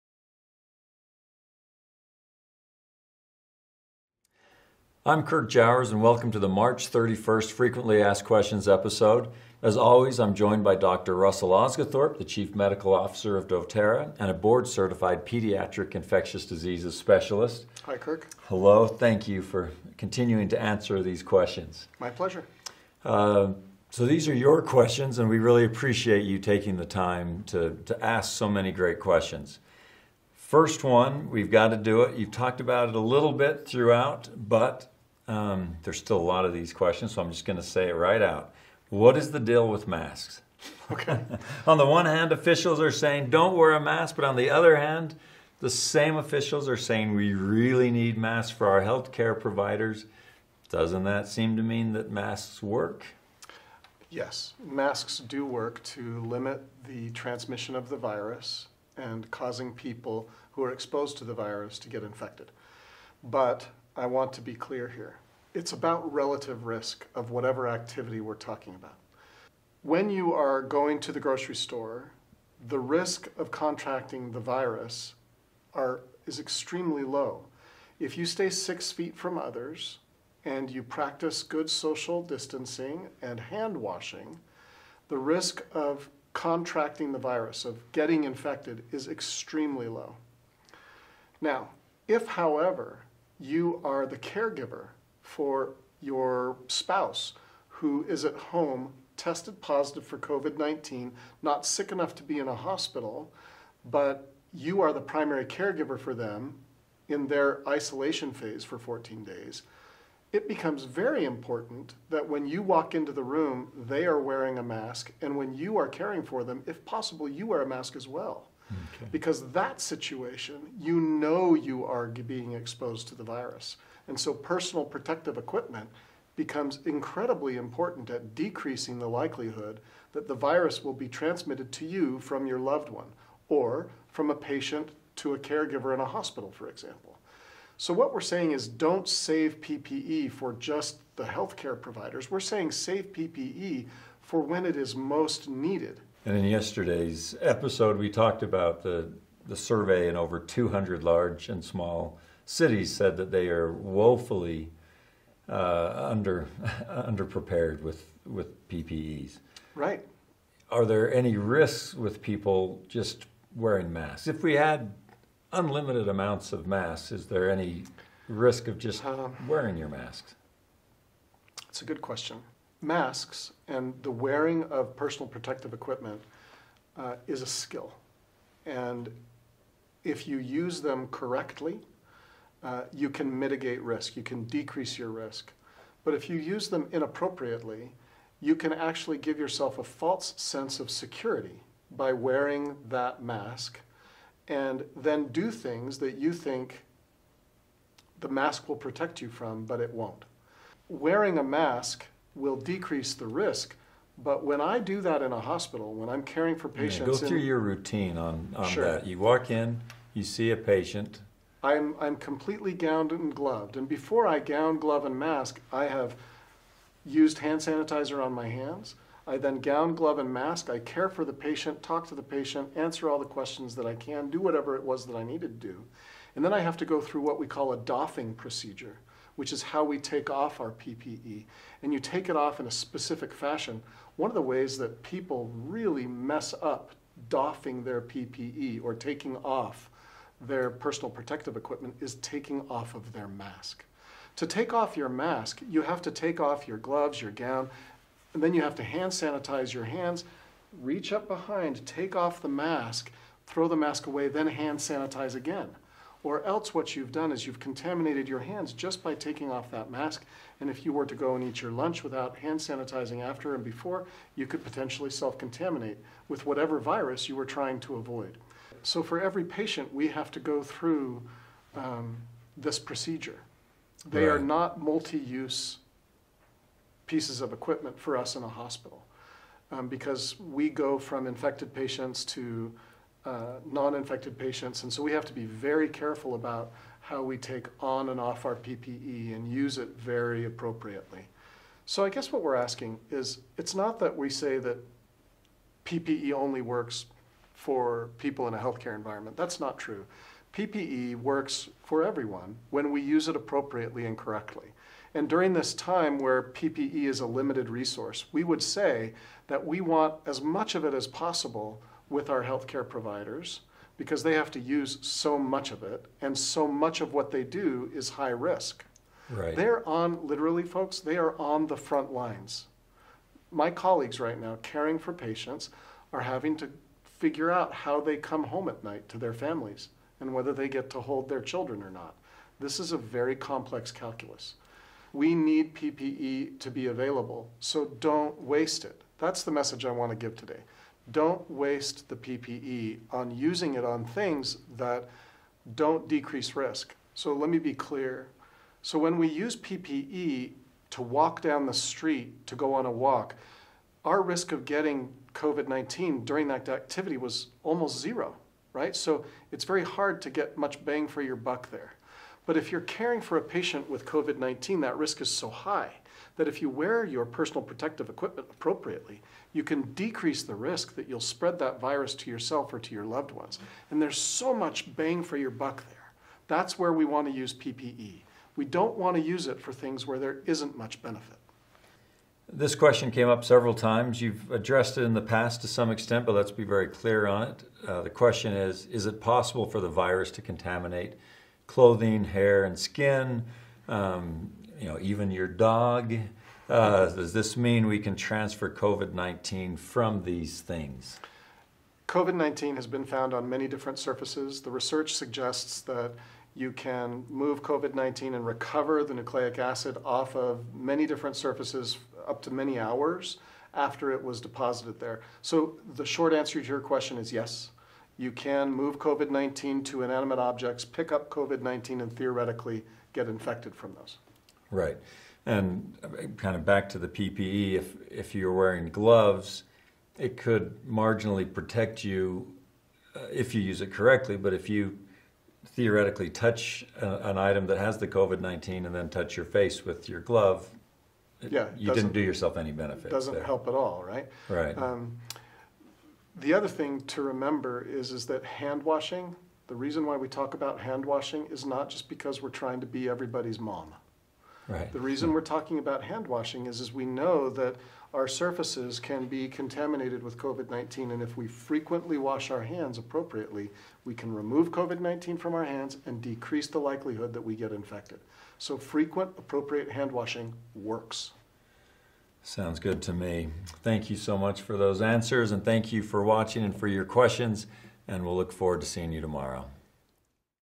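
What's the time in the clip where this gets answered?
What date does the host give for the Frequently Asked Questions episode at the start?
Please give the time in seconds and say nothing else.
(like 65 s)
6 s.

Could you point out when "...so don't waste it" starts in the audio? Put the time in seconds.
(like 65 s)
337 s.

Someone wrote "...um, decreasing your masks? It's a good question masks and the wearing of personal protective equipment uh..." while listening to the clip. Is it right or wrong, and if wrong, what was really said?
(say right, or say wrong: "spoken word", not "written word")
wrong: "wearing", not "decreasing".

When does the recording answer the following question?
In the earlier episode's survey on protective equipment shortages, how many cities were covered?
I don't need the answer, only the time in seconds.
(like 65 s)
150 s.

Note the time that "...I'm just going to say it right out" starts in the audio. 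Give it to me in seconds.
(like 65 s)
37 s.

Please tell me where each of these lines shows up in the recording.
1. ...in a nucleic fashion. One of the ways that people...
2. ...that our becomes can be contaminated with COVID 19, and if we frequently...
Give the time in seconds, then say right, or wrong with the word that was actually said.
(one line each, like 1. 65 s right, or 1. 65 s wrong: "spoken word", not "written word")
1. 232 s wrong: "specific", not "nucleic"
2. 457 s wrong: "surfaces", not "becomes".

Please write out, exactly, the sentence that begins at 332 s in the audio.
This is a very complex calculus.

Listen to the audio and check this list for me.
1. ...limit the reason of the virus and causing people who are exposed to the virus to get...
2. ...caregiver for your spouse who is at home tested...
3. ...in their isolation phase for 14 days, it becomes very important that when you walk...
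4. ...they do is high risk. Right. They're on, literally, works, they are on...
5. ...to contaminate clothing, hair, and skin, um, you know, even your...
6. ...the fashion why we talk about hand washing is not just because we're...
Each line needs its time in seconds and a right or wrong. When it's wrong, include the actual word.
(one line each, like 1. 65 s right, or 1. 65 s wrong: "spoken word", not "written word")
1. 56 s wrong: "transmission", not "reason"
2. 94 s right
3. 107 s right
4. 317 s wrong: "folks", not "works"
5. 390 s right
6. 449 s wrong: "reason", not "fashion".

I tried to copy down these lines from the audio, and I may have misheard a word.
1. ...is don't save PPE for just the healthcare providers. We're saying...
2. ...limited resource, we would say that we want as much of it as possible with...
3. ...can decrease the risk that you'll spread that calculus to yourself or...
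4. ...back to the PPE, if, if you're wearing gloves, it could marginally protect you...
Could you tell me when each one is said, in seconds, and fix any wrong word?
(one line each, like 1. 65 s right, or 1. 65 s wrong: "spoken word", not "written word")
1. 138 s right
2. 307 s right
3. 369 s wrong: "virus", not "calculus"
4. 426 s right.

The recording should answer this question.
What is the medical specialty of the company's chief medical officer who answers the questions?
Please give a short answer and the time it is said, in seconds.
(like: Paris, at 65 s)
pediatric infectious diseases, at 15 s.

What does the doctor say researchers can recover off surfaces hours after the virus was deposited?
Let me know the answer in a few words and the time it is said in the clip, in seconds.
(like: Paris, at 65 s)
nucleic acid, at 409 s.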